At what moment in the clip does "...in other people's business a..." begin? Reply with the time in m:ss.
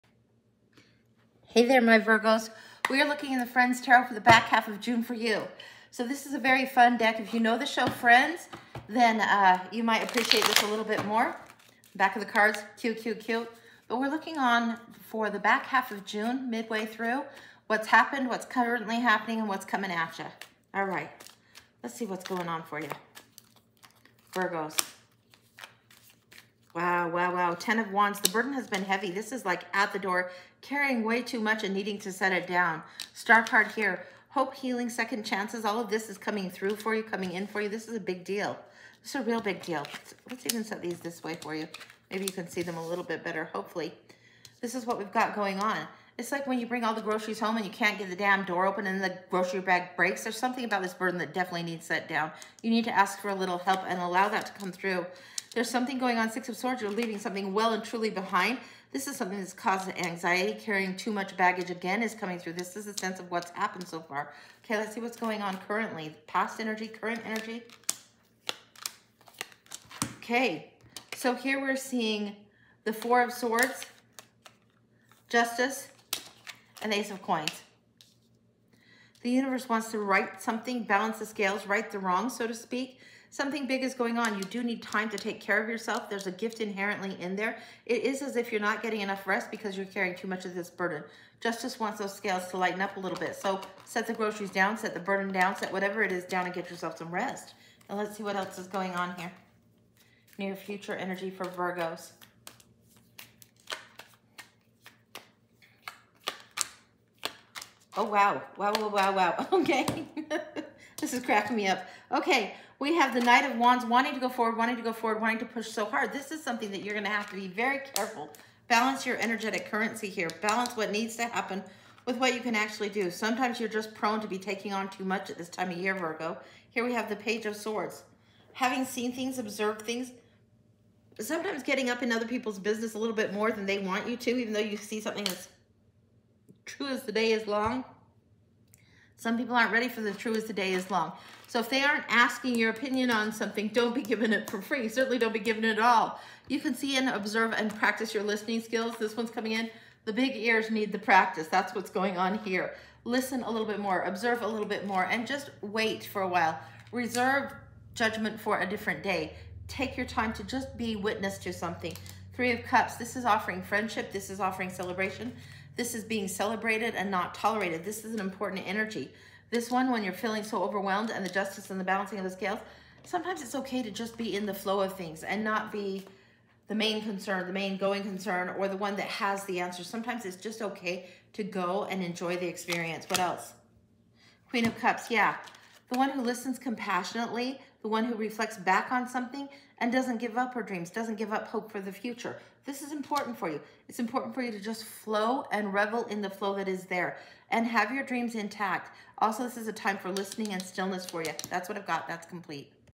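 2:12.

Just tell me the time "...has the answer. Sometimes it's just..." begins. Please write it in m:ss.
2:59.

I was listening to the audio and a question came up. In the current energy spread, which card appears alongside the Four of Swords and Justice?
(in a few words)
Ace of Coins.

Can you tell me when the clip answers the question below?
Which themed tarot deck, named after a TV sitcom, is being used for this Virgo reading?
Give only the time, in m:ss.
0:03.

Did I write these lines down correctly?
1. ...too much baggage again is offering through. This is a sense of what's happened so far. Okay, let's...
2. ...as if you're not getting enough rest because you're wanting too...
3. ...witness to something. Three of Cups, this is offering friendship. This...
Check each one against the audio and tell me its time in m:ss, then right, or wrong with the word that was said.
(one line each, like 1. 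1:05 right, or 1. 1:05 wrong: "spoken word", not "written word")
1. 1:00 wrong: "coming", not "offering"
2. 1:28 wrong: "carrying", not "wanting"
3. 2:40 right.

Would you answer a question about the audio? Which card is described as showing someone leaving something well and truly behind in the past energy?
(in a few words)
Six of Swords.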